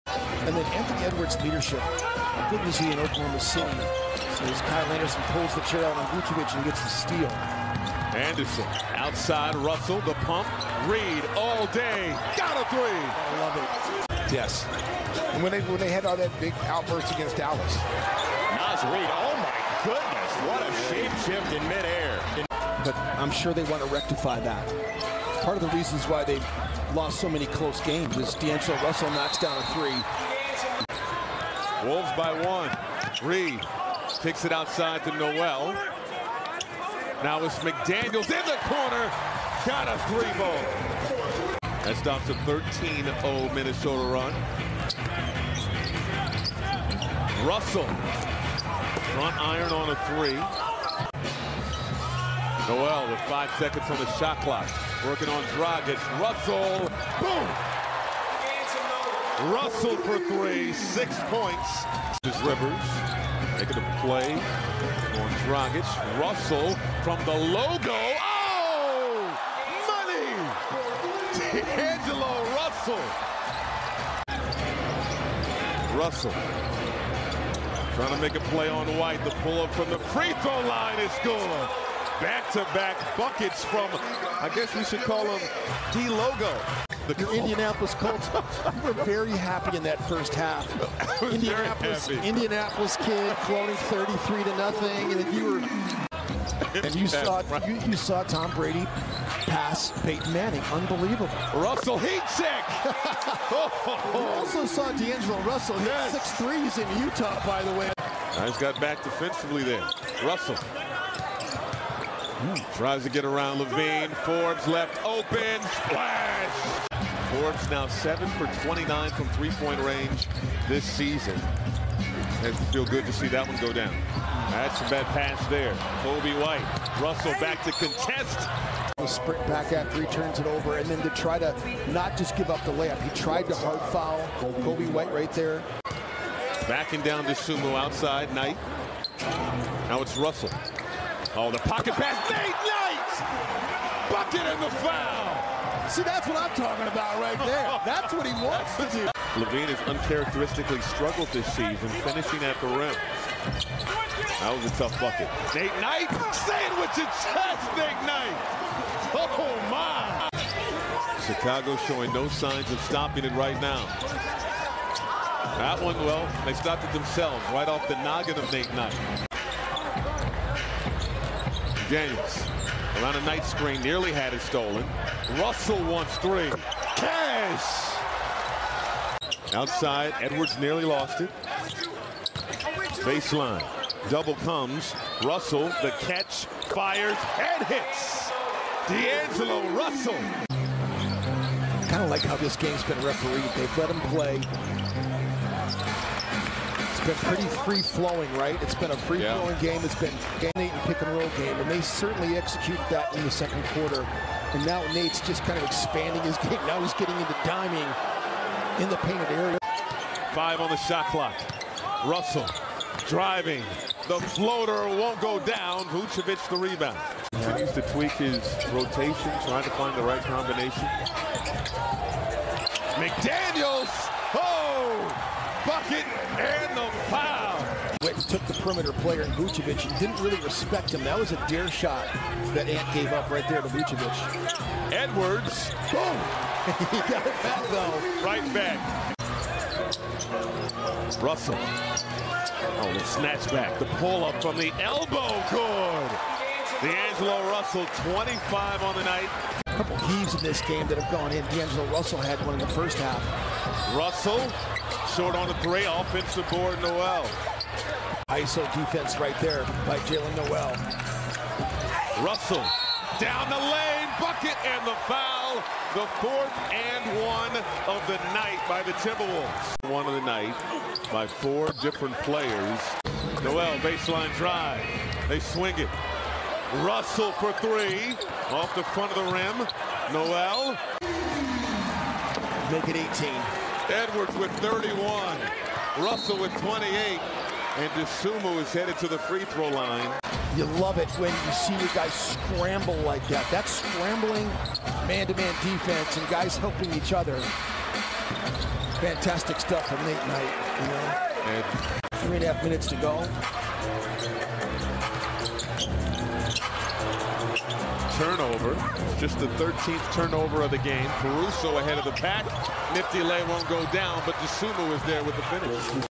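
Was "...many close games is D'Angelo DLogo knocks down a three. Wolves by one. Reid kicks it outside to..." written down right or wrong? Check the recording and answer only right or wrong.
wrong.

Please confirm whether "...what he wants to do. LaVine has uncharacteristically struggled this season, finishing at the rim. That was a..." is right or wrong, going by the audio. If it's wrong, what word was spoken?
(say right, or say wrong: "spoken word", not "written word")
right.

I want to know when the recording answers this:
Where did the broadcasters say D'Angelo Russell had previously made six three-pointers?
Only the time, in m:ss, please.
1:47.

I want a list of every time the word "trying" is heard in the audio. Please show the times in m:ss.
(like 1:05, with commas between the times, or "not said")
1:17, 3:39.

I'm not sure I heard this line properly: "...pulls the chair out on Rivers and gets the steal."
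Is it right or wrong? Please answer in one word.
wrong.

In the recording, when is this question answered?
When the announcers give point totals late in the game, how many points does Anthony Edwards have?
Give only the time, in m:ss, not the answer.
4:44.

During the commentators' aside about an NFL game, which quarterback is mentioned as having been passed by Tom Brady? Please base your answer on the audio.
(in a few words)
Peyton Manning.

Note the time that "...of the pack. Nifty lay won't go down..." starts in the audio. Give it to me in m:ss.
5:11.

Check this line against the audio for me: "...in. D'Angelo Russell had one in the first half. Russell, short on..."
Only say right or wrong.
right.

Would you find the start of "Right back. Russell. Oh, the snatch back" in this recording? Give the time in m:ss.
3:58.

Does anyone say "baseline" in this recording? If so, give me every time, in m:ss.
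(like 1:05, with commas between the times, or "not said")
3:03, 4:33.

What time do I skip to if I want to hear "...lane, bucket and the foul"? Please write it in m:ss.
4:23.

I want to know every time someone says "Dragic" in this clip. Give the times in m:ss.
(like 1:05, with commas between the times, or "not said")
0:55, 1:05.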